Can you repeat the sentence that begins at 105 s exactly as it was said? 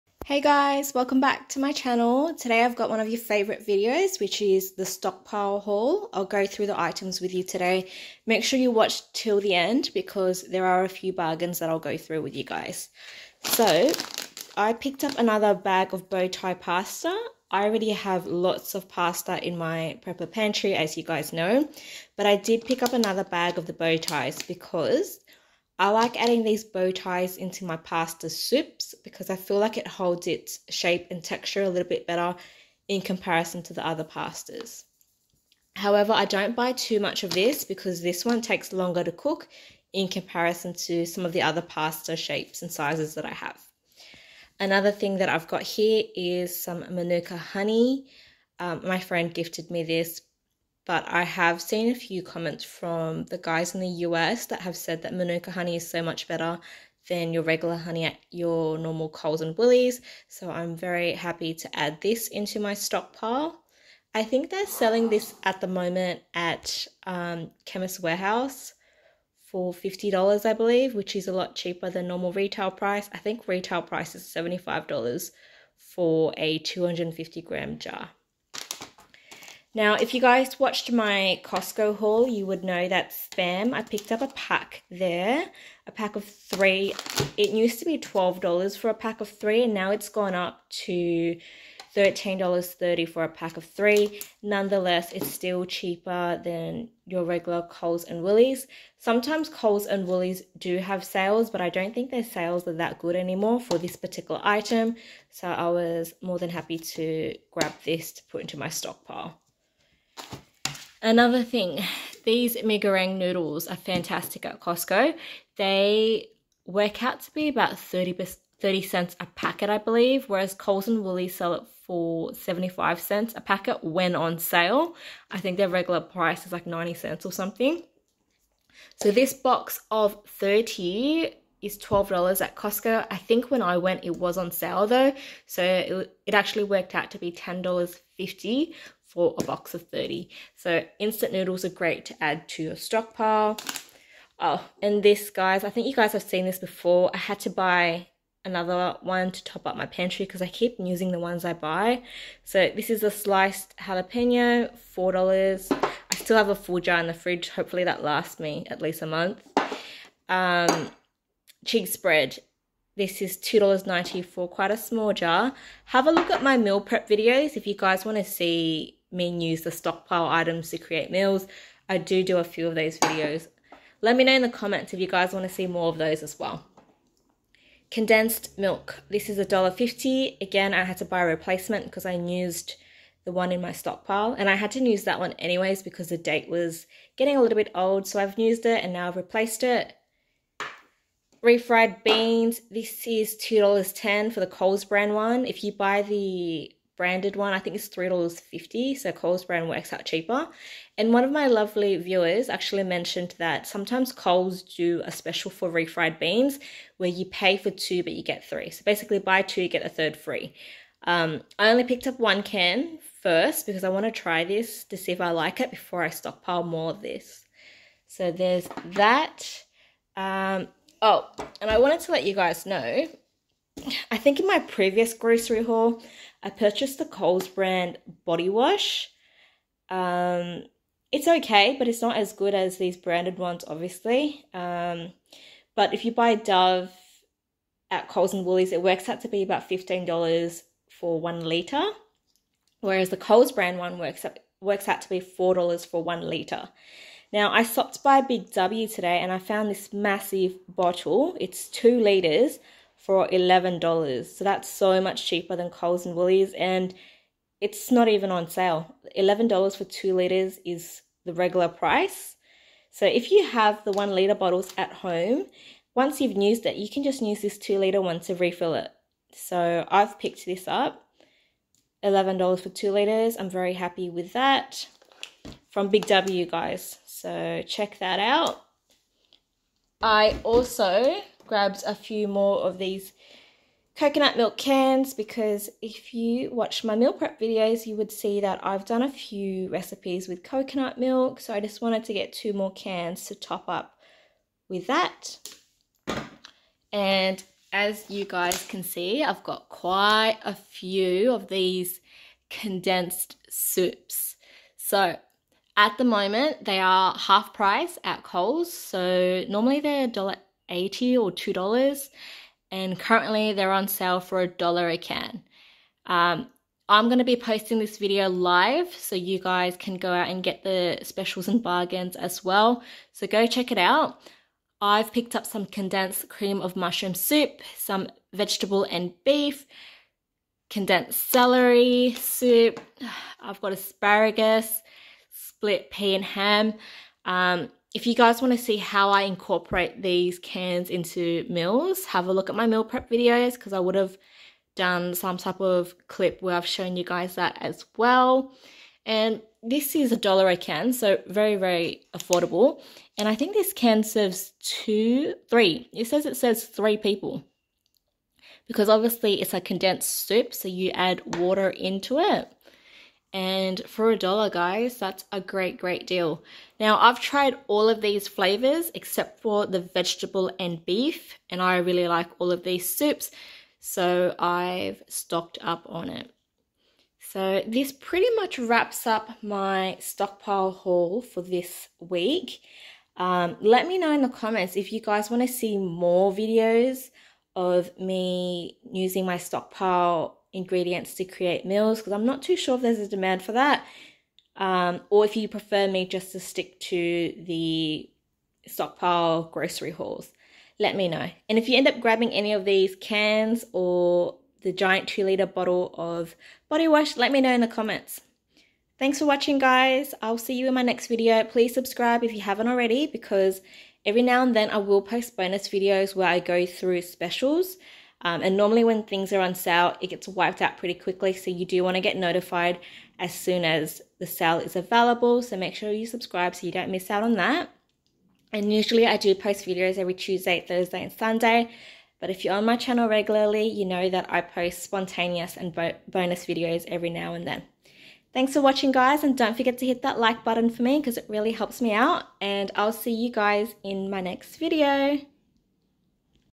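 So I was more than happy to grab this to put into my stockpile.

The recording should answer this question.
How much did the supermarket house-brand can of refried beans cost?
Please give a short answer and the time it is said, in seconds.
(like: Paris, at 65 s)
$2.10, at 193 s.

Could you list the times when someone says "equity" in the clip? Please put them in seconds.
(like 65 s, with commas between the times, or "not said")
not said.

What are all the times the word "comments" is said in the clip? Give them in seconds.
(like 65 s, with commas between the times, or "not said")
52 s, 174 s, 384 s, 407 s.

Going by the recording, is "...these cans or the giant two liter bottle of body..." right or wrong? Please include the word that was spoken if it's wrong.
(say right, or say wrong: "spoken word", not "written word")
right.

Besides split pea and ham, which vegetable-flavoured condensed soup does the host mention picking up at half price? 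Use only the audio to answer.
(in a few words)
asparagus.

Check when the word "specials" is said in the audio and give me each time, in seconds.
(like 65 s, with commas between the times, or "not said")
205 s, 321 s, 417 s.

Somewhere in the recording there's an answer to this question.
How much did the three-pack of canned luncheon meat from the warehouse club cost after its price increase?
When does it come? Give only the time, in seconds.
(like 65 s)
91 s.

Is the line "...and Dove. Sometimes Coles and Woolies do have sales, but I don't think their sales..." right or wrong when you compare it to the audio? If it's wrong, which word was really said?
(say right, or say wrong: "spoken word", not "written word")
wrong: "Woolies", not "Dove".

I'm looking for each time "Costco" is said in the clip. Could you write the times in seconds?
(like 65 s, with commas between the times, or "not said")
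81 s, 114 s, 132 s.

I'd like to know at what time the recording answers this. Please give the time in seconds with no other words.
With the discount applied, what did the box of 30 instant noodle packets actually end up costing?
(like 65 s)
137 s.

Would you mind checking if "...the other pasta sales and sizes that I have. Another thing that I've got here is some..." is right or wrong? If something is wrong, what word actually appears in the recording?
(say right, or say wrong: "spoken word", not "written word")
wrong: "shapes", not "sales".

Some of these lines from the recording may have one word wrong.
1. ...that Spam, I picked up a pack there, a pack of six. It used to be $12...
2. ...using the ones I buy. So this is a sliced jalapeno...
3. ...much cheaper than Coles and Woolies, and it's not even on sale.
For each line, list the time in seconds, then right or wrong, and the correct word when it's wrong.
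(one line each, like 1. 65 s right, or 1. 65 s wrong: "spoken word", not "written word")
1. 82 s wrong: "three", not "six"
2. 150 s right
3. 255 s right.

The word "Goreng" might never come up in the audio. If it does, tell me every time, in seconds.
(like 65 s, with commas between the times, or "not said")
112 s.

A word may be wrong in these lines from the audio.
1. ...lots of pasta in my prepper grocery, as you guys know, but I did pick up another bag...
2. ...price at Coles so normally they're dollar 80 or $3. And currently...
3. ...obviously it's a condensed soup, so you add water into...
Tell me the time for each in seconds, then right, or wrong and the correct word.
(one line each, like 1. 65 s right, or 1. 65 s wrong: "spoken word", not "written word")
1. 18 s wrong: "pantry", not "grocery"
2. 307 s wrong: "2", not "3"
3. 358 s right.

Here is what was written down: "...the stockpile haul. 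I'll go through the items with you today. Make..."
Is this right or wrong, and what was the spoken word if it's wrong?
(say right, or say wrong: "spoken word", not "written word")
right.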